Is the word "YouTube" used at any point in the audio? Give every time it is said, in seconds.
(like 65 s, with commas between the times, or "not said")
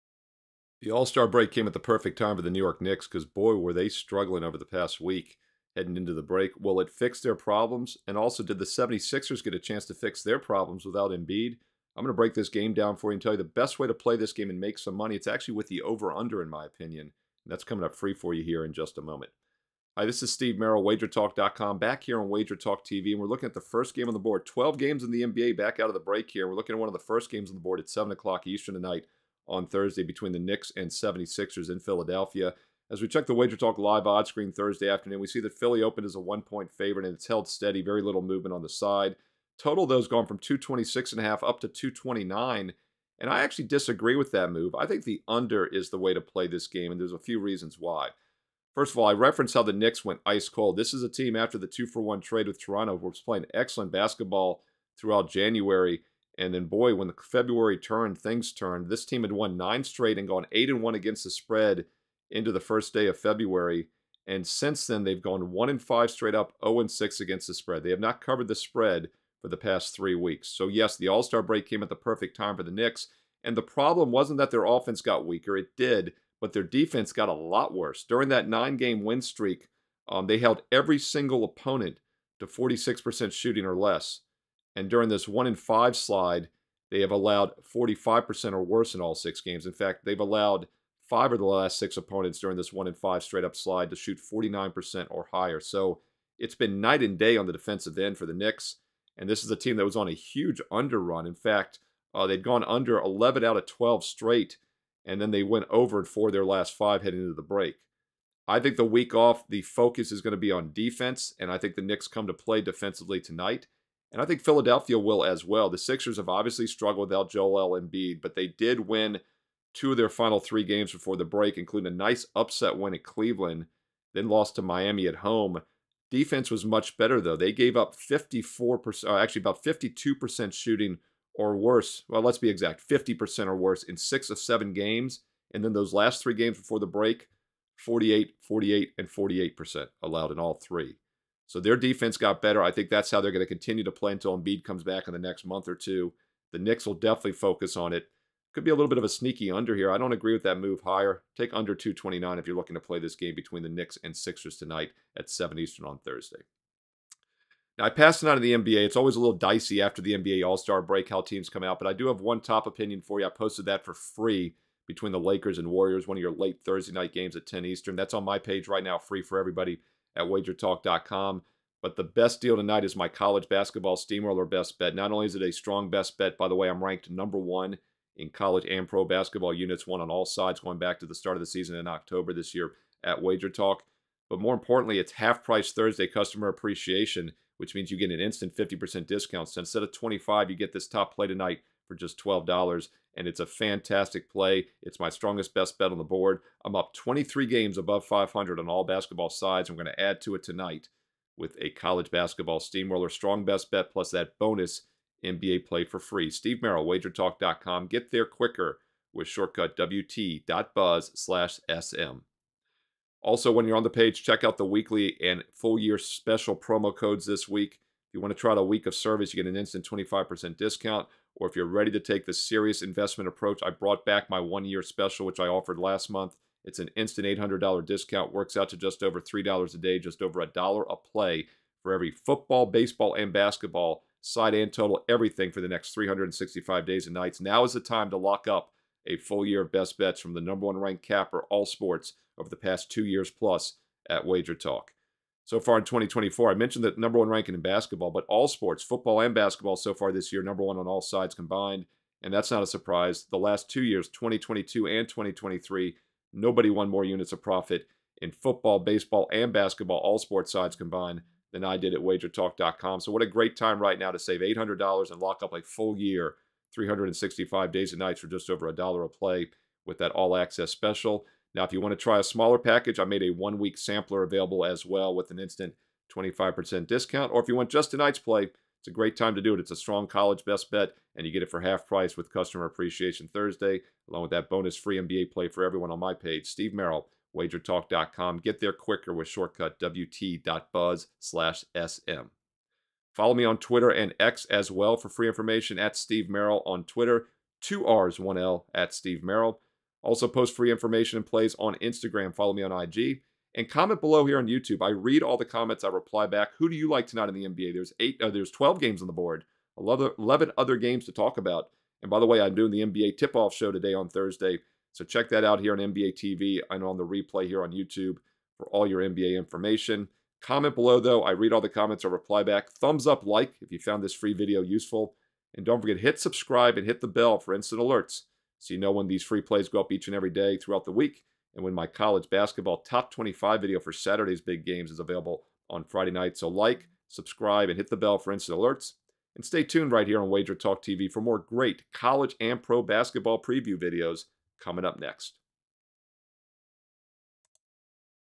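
304 s, 317 s.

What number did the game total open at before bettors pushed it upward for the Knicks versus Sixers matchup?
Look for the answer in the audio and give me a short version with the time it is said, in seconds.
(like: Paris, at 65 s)
226.5, at 40 s.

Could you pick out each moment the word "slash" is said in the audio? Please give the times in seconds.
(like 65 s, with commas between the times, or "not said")
211 s, 291 s.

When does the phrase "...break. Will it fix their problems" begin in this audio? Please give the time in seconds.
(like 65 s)
6 s.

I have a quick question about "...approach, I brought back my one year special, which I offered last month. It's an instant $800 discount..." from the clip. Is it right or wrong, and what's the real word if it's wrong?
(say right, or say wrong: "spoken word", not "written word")
right.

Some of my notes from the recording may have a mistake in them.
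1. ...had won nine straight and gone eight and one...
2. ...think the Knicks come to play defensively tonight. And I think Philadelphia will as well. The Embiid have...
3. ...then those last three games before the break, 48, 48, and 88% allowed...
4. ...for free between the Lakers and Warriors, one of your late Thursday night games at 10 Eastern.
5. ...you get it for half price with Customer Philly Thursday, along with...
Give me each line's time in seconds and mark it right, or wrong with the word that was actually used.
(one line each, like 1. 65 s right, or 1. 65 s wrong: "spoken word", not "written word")
1. 59 s right
2. 111 s wrong: "Sixers", not "Embiid"
3. 135 s wrong: "48", not "88"
4. 163 s right
5. 281 s wrong: "Appreciation", not "Philly".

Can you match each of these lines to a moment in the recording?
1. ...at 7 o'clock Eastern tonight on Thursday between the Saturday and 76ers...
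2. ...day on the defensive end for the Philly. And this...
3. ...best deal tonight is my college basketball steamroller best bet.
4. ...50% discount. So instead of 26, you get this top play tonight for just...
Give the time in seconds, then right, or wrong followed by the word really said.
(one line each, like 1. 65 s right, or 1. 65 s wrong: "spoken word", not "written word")
1. 27 s wrong: "Knicks", not "Saturday"
2. 97 s wrong: "Knicks", not "Philly"
3. 172 s right
4. 188 s wrong: "25", not "26".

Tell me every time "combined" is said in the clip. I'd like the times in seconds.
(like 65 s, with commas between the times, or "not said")
251 s, 260 s.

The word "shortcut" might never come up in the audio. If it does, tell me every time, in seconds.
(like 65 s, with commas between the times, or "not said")
209 s, 289 s.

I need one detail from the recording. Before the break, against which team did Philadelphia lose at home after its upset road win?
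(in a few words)
Miami.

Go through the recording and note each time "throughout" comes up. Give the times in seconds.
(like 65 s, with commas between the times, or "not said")
54 s, 330 s.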